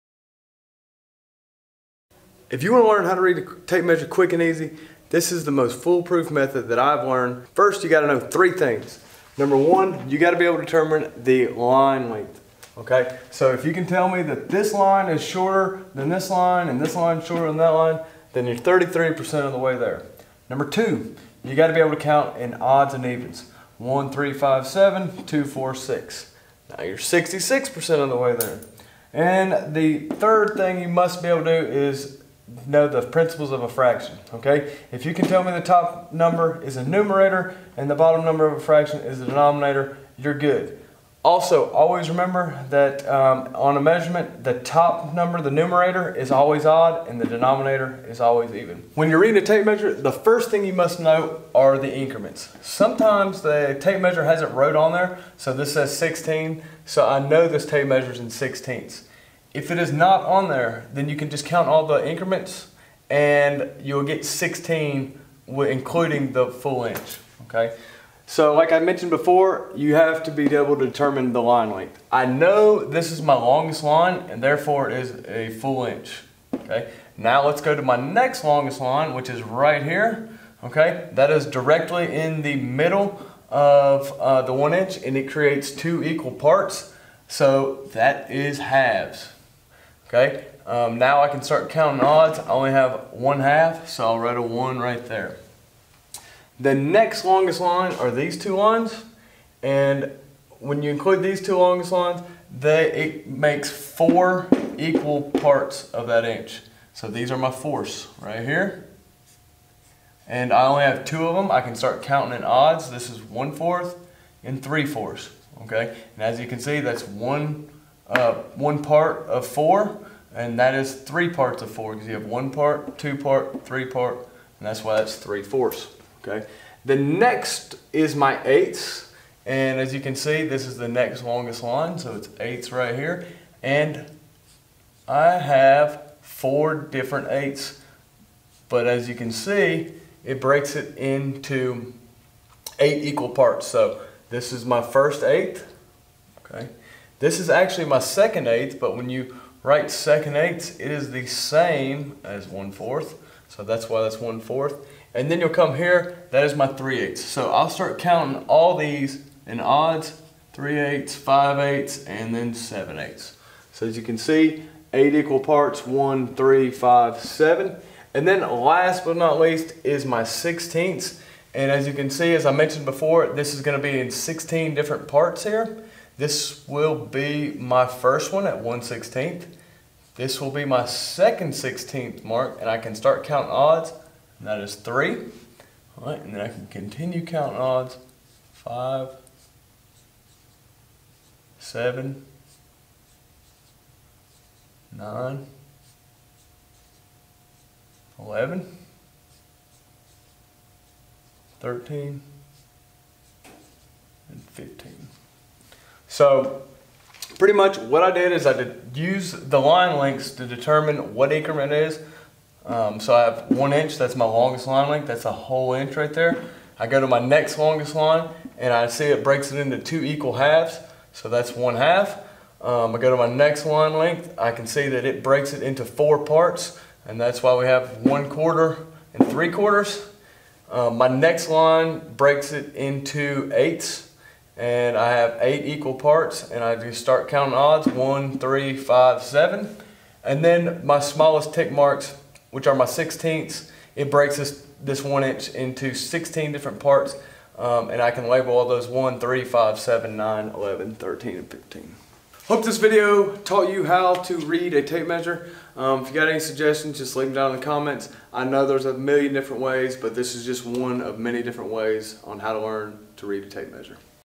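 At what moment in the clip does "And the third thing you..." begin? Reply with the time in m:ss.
0:29.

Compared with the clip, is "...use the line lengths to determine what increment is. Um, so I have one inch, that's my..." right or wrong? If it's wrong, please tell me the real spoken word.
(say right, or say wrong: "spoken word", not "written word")
right.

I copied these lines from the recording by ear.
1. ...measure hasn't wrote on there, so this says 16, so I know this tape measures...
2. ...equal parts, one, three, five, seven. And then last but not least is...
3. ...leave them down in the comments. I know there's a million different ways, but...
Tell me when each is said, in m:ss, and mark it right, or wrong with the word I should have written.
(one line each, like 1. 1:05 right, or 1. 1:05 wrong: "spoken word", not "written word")
1. 0:54 right
2. 2:45 right
3. 4:17 right.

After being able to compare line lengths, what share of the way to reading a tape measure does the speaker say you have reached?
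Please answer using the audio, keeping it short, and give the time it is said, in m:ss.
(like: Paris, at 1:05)
33%, at 0:18.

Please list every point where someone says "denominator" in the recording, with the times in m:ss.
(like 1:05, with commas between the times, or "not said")
0:39, 0:47.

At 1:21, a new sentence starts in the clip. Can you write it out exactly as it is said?
That is directly in the middle of uh, the one inch and it creates two equal parts.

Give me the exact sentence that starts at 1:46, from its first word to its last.
So these are my fourths right here.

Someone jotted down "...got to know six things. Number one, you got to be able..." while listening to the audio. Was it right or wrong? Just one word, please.
wrong.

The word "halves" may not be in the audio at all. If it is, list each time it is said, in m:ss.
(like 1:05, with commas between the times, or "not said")
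1:28, 3:40.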